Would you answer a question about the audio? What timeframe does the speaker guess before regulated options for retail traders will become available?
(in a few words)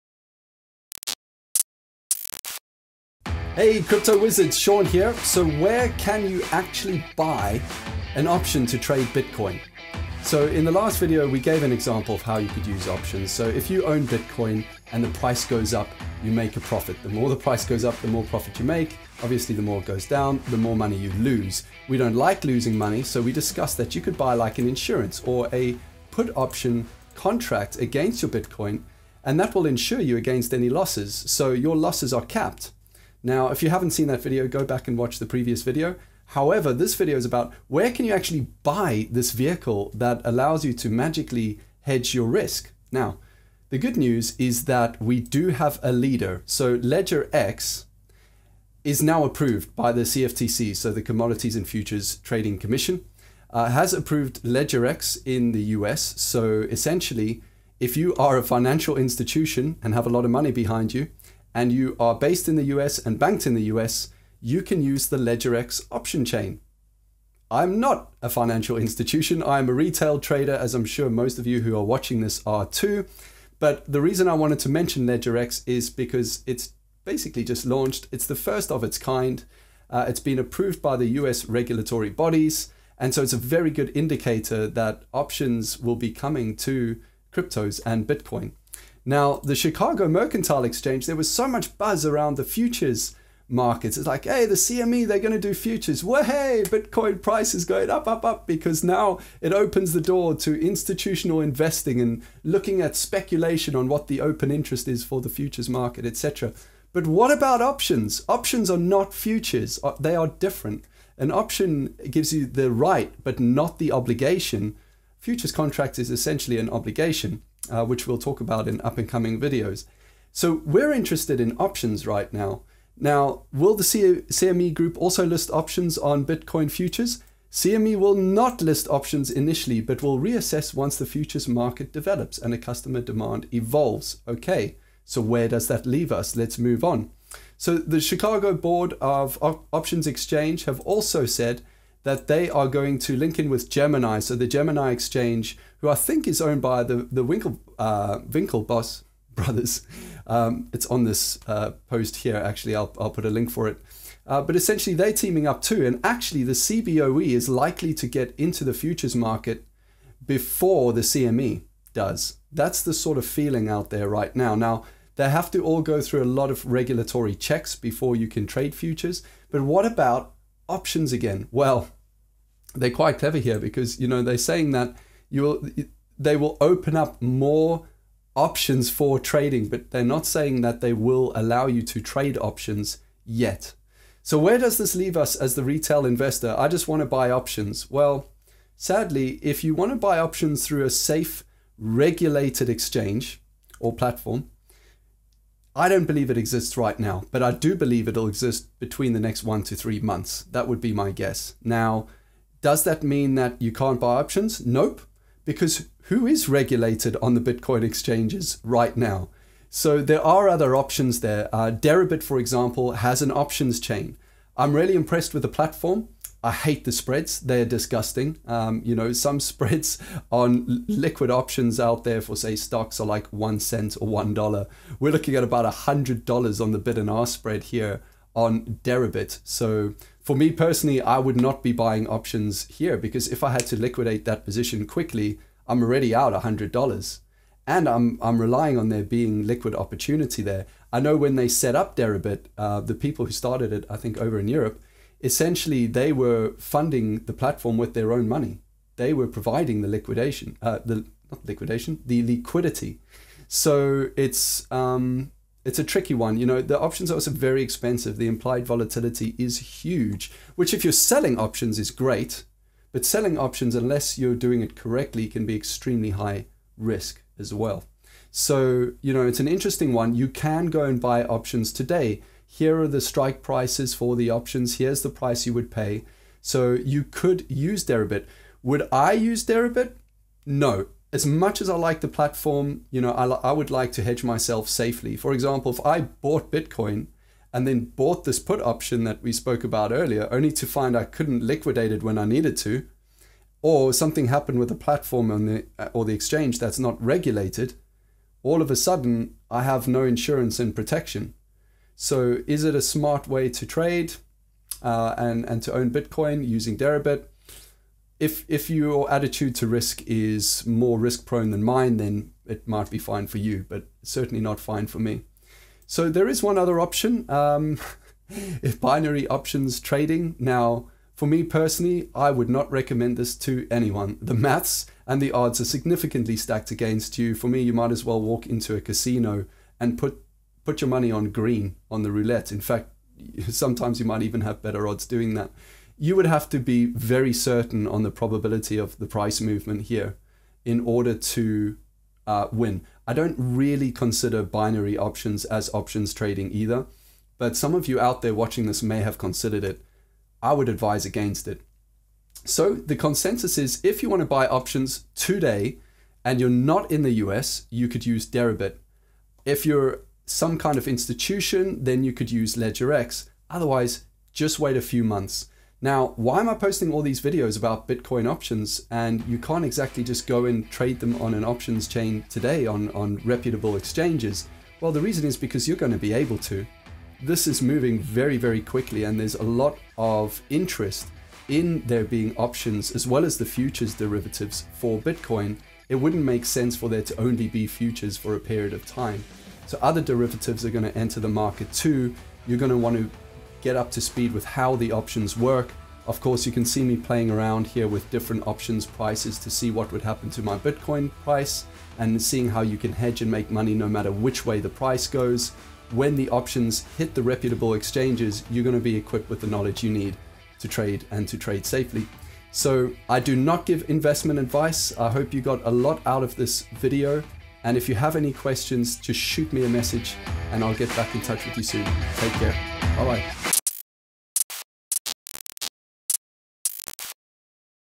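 1 to 3 months.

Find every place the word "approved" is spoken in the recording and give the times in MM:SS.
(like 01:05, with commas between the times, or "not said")
00:49, 00:53, 01:20.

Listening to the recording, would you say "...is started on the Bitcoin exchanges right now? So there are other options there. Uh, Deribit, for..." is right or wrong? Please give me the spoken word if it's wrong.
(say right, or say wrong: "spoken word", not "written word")
wrong: "regulated", not "started".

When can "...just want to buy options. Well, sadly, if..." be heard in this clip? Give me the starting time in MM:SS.
03:06.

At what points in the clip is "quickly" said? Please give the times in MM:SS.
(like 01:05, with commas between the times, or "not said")
03:54, 06:18.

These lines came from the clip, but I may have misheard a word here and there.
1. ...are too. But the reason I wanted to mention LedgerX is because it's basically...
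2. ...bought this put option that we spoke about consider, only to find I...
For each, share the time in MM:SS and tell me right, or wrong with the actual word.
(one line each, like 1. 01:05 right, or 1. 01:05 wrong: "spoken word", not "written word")
1. 01:12 right
2. 04:47 wrong: "earlier", not "consider".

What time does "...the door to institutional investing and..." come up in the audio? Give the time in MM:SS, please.
01:39.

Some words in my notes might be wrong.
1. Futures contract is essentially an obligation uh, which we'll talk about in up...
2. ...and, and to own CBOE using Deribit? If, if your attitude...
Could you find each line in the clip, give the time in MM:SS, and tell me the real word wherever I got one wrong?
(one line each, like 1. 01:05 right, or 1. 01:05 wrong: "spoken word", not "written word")
1. 01:55 right
2. 05:05 wrong: "Bitcoin", not "CBOE".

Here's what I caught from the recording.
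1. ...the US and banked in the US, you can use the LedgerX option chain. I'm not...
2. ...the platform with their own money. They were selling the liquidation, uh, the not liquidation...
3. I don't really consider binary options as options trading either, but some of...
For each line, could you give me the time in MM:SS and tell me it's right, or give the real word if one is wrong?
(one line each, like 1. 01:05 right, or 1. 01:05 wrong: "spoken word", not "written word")
1. 01:02 right
2. 04:07 wrong: "providing", not "selling"
3. 05:43 right.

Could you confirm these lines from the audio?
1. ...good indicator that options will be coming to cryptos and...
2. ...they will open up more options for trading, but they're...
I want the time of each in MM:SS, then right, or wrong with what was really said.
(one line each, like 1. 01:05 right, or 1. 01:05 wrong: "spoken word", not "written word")
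1. 01:23 right
2. 02:56 right.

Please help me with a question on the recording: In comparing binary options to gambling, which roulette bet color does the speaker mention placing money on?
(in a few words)
green.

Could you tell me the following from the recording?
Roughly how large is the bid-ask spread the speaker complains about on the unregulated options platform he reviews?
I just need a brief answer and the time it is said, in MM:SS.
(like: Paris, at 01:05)
$100, at 03:45.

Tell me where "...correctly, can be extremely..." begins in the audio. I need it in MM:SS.
04:24.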